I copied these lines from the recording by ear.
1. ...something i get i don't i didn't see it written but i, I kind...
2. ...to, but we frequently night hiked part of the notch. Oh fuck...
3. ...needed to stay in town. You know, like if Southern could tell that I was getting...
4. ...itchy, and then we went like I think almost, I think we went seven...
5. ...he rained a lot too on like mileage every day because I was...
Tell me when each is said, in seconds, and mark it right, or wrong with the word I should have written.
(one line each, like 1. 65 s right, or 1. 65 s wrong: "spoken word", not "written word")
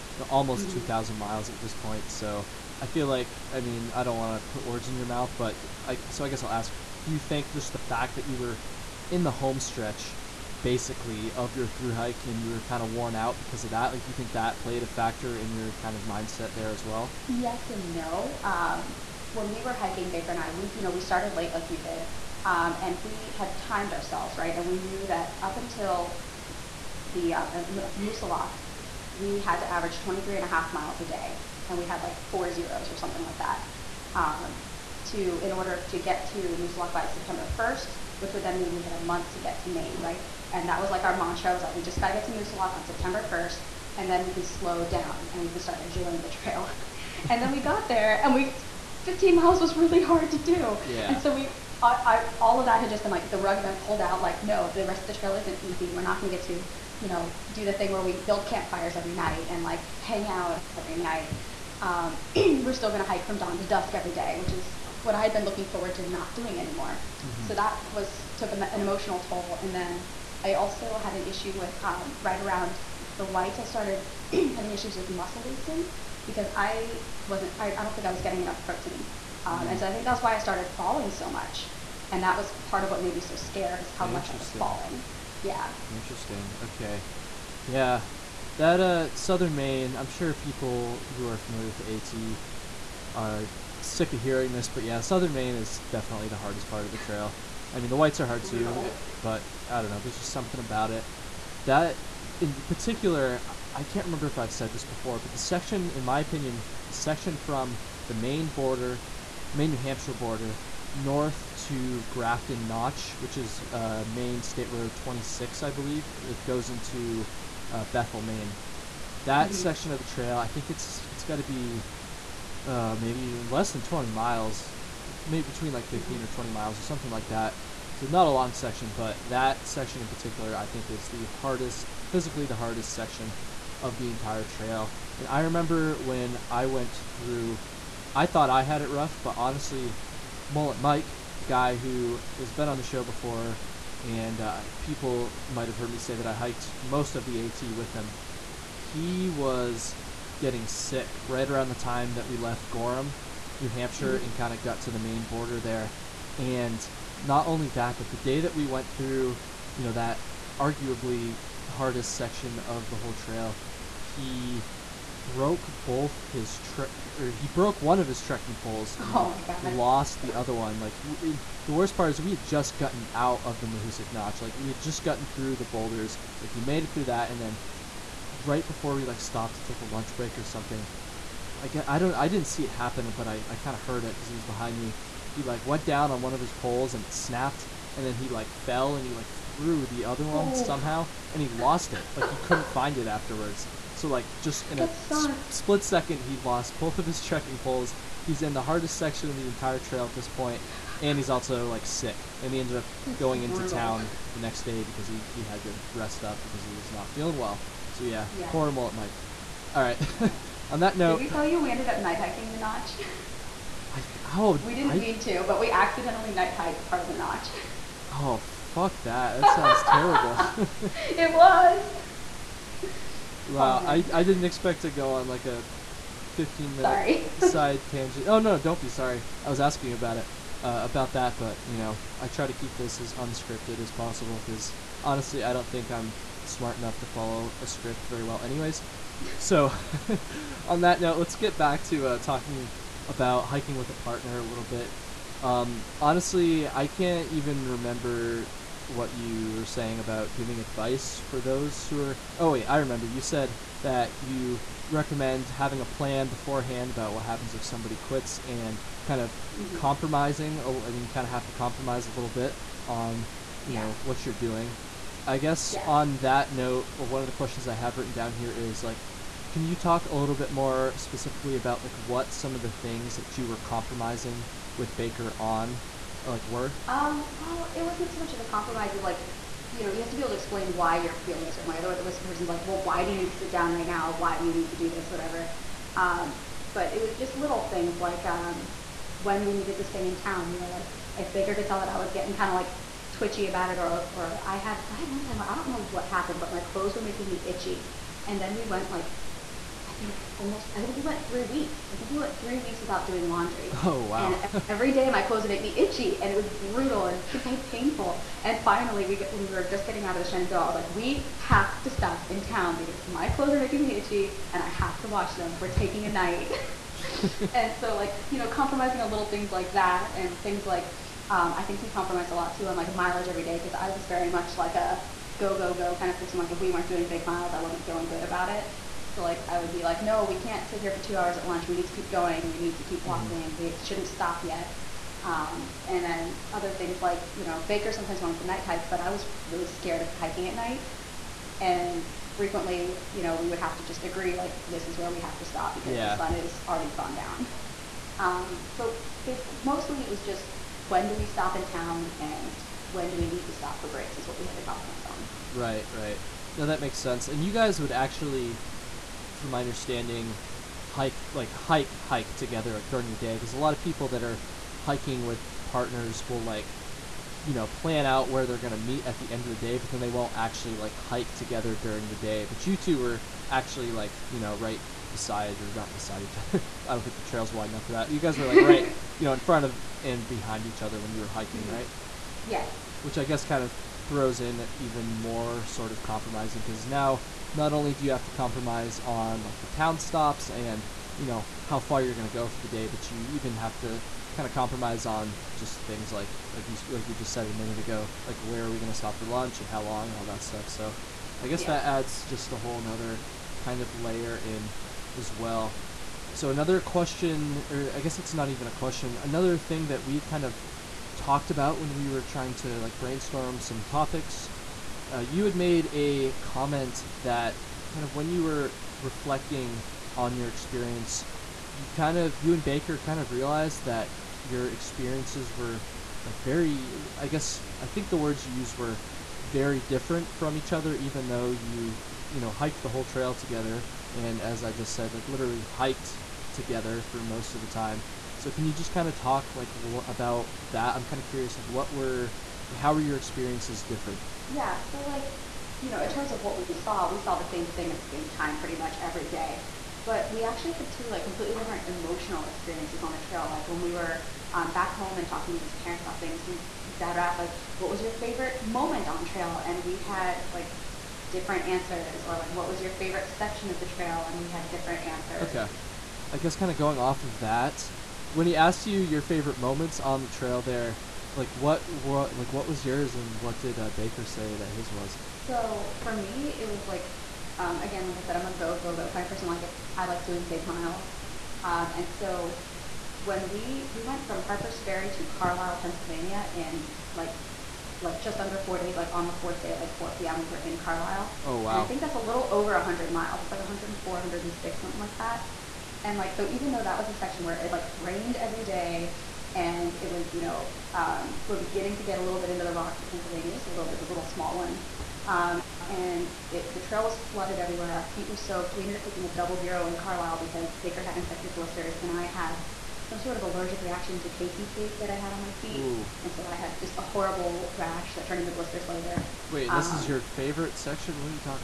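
1. 180 s wrong: "happen", not "written"
2. 215 s wrong: "accidentally", not "frequently"
3. 289 s wrong: "Baker", not "Southern"
4. 297 s wrong: "three", not "seven"
5. 321 s wrong: "compromised", not "rained".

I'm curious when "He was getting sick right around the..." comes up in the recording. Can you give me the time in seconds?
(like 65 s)
148 s.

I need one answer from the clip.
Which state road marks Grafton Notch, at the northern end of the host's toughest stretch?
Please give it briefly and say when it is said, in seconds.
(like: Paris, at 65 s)
Maine State Road 26, at 114 s.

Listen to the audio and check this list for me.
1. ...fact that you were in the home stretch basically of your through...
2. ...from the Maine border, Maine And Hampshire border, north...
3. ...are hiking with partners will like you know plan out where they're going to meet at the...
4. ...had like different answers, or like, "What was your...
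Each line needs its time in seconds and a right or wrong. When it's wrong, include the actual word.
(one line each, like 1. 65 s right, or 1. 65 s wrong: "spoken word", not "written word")
1. 7 s right
2. 107 s wrong: "New", not "And"
3. 364 s right
4. 459 s right.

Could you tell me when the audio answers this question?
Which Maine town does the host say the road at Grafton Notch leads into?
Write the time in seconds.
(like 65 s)
117 s.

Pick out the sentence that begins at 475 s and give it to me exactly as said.
So for me, it was like um, again, like I said, I'm a go go go kind of person.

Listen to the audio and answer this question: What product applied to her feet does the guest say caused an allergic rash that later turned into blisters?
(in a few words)
KT tape.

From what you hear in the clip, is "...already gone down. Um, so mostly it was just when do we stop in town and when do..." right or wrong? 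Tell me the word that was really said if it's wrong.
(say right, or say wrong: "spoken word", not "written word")
right.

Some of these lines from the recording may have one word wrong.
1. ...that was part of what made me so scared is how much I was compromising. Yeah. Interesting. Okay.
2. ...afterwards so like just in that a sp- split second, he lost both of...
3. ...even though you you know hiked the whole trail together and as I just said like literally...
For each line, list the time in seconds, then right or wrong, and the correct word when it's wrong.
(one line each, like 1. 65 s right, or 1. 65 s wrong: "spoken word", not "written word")
1. 82 s wrong: "falling", not "compromising"
2. 193 s right
3. 430 s right.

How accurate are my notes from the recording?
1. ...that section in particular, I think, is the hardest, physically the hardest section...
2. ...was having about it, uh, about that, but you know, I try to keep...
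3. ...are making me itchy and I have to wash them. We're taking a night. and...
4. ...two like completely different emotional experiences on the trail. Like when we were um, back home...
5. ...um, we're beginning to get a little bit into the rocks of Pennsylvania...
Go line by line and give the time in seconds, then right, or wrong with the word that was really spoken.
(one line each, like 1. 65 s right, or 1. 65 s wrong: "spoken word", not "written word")
1. 129 s right
2. 229 s wrong: "asking", not "having"
3. 313 s right
4. 450 s right
5. 500 s right.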